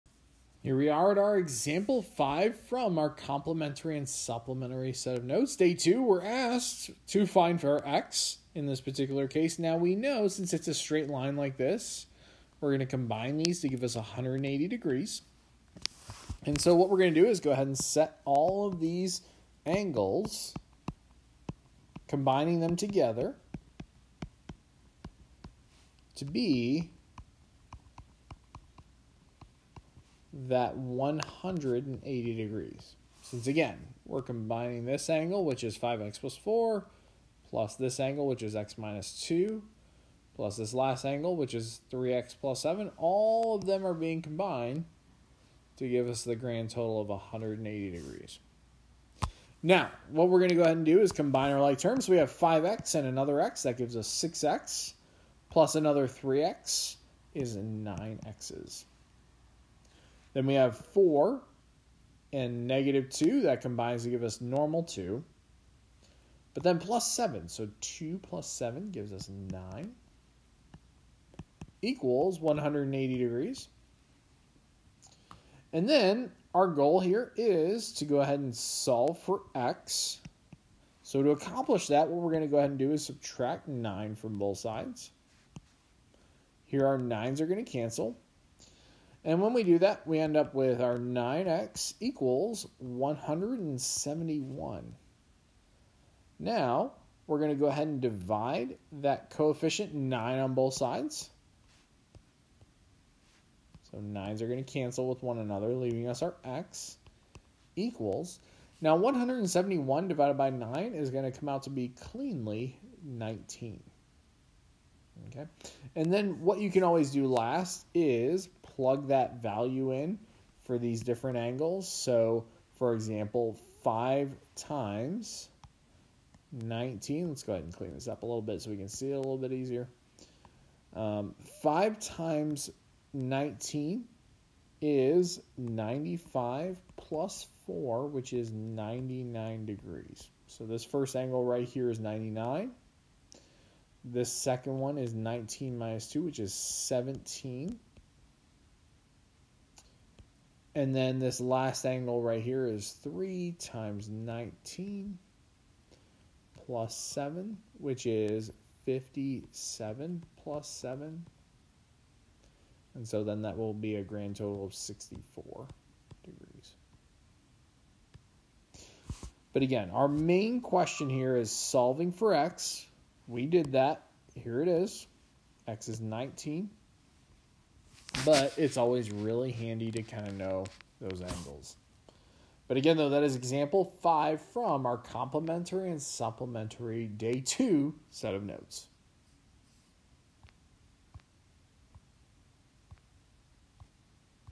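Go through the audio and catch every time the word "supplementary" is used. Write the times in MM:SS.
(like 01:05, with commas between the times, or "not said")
00:04, 03:06.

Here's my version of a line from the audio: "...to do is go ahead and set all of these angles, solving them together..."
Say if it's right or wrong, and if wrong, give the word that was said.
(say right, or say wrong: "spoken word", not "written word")
wrong: "combining", not "solving".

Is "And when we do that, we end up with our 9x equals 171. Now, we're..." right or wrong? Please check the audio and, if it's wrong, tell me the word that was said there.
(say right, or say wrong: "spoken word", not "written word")
right.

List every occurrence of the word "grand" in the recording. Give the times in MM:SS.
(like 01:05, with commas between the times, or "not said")
00:46, 02:44.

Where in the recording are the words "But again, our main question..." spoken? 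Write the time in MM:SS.
02:49.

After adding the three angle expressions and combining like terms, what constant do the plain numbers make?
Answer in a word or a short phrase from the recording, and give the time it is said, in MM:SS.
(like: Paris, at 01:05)
9, at 01:07.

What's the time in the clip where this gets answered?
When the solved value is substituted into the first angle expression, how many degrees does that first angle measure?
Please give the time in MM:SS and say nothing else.
02:18.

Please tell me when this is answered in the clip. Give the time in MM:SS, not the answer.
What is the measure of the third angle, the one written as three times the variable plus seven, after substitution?
02:44.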